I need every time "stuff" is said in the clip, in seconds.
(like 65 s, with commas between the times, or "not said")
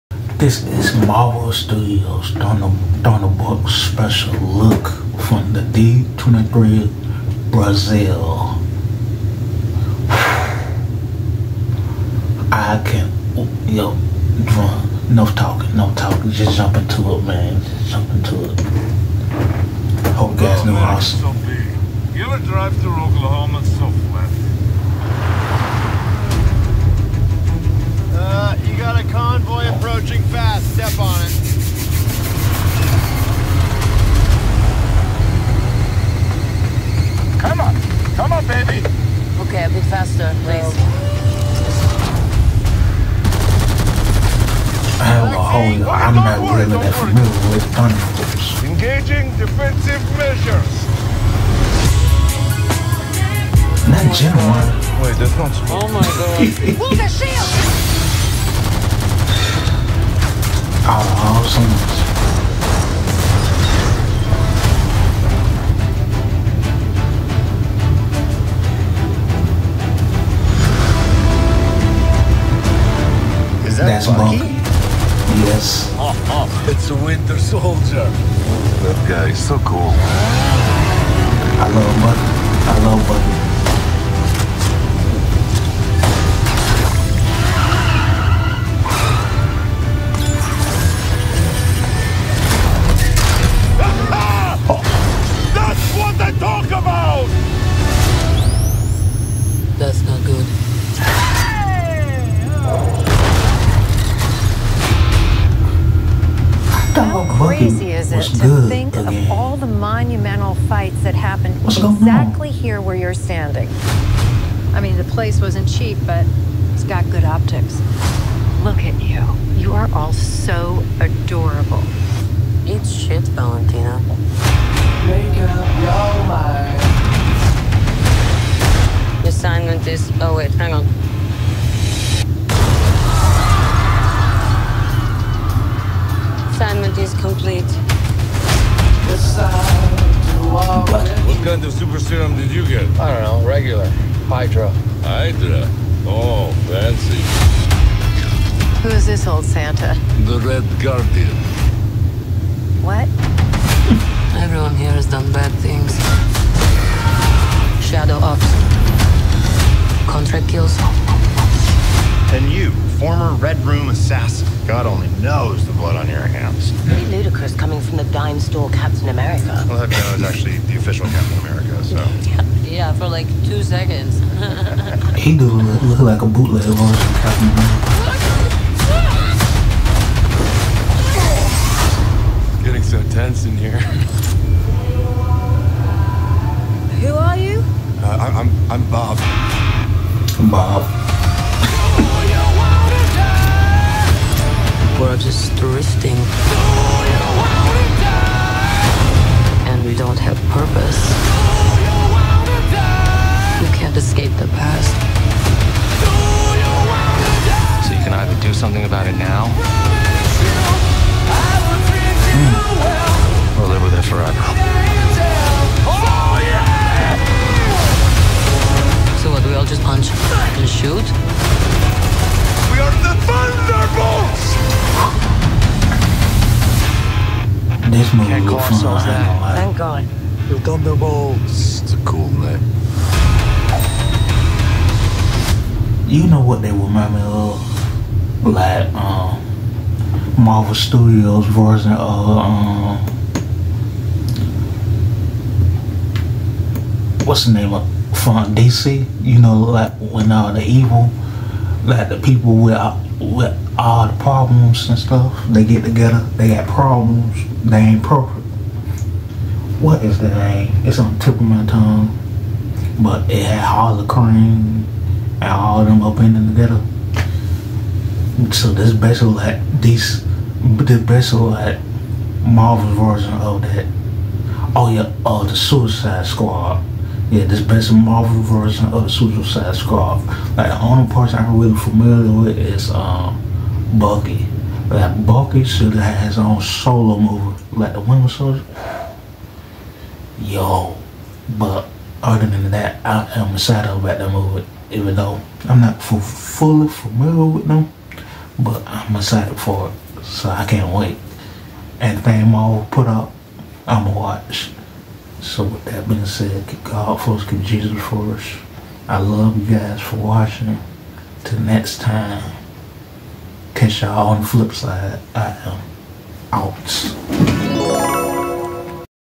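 254 s.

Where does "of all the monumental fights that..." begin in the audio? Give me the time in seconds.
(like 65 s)
109 s.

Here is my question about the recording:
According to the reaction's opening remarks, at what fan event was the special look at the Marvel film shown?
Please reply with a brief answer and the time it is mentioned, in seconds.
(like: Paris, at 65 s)
D23 Brazil, at 5 s.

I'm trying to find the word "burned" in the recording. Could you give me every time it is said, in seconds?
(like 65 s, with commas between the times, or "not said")
not said.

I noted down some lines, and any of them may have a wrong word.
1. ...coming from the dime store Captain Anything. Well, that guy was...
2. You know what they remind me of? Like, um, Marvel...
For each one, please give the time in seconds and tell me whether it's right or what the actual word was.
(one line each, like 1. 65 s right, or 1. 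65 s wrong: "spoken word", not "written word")
1. 167 s wrong: "America", not "Anything"
2. 236 s right.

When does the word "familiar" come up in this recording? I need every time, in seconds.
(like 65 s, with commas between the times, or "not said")
46 s, 281 s, 296 s.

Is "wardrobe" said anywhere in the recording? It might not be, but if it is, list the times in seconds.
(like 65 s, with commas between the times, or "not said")
not said.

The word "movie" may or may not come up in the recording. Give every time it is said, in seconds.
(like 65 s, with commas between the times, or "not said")
228 s, 287 s, 294 s.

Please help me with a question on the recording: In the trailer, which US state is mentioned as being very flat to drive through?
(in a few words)
Oklahoma.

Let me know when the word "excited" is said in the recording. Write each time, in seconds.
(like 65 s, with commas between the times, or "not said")
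293 s, 299 s.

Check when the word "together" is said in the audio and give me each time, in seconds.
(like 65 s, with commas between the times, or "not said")
255 s, 266 s.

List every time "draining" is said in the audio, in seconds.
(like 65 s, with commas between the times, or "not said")
not said.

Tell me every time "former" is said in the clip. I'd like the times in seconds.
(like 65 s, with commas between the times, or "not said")
162 s.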